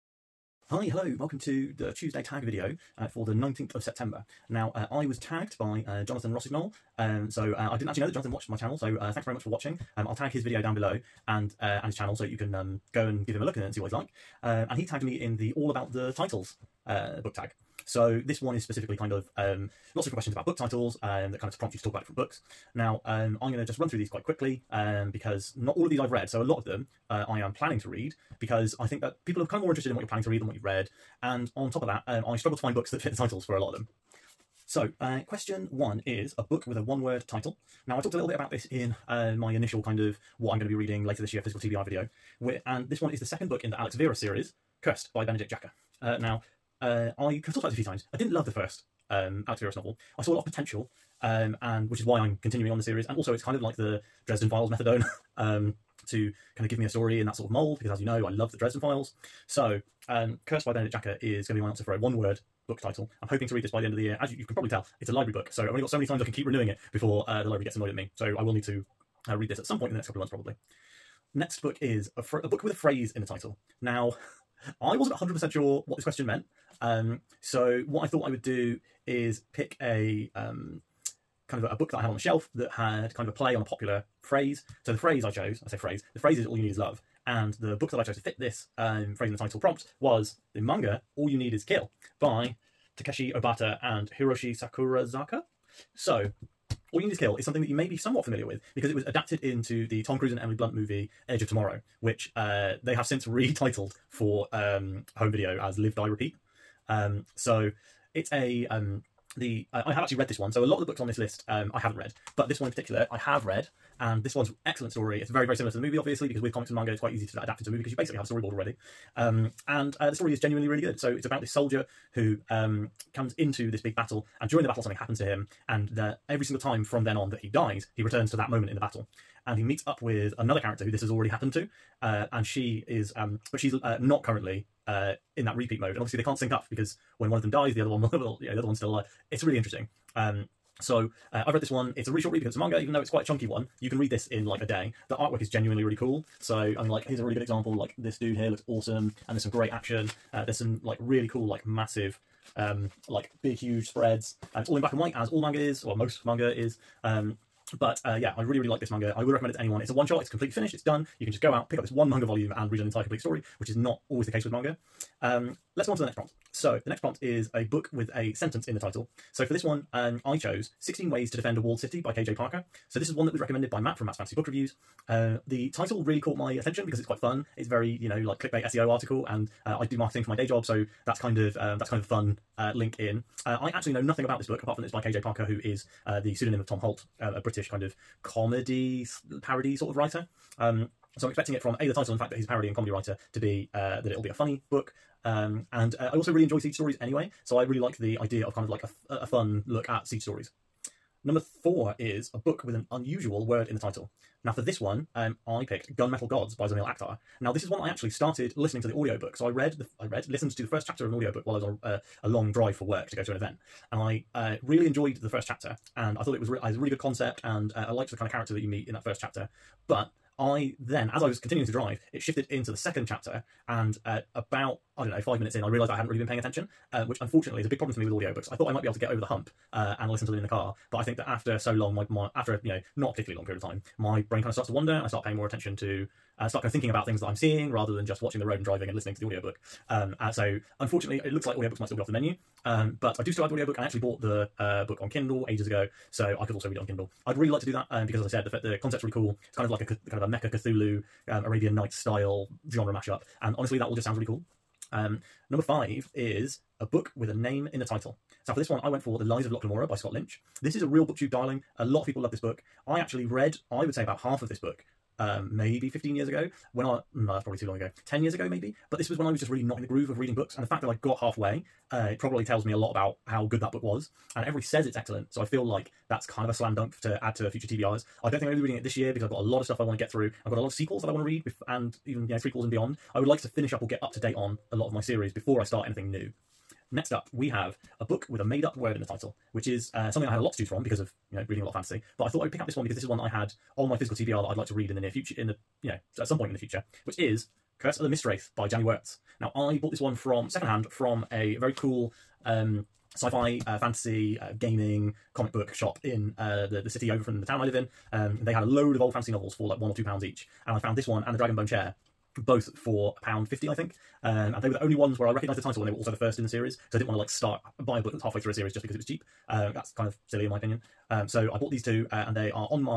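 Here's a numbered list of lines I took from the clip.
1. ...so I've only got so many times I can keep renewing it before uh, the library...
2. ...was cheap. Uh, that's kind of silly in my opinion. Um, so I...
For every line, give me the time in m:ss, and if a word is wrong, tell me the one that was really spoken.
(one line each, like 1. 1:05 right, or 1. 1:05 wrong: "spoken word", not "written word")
1. 1:05 right
2. 5:18 right.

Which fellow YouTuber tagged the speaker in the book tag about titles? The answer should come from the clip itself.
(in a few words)
Jonathan Rossignol.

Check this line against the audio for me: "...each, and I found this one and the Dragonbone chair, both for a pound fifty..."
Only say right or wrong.
right.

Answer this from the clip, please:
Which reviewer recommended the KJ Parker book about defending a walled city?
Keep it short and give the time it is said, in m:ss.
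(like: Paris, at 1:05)
Matt from Matt's Fantasy Book Reviews, at 2:53.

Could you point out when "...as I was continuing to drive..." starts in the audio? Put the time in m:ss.
3:41.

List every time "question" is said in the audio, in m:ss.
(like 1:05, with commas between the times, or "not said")
0:20, 0:35, 1:16.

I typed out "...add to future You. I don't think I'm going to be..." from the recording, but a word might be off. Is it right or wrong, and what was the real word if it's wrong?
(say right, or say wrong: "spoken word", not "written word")
wrong: "TBRs", not "You".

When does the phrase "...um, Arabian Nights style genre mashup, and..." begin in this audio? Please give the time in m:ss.
4:11.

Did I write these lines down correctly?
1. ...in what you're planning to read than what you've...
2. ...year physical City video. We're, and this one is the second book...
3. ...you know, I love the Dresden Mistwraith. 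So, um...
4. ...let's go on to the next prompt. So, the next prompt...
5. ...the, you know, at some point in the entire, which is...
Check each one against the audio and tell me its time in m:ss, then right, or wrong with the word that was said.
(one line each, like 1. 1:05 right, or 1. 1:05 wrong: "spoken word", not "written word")
1. 0:29 right
2. 0:41 wrong: "TBR", not "City"
3. 0:58 wrong: "Files", not "Mistwraith"
4. 2:45 right
5. 4:55 wrong: "future", not "entire".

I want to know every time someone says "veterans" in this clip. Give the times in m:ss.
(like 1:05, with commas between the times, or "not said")
not said.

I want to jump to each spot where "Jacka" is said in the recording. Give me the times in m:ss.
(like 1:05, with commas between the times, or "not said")
0:45, 1:00.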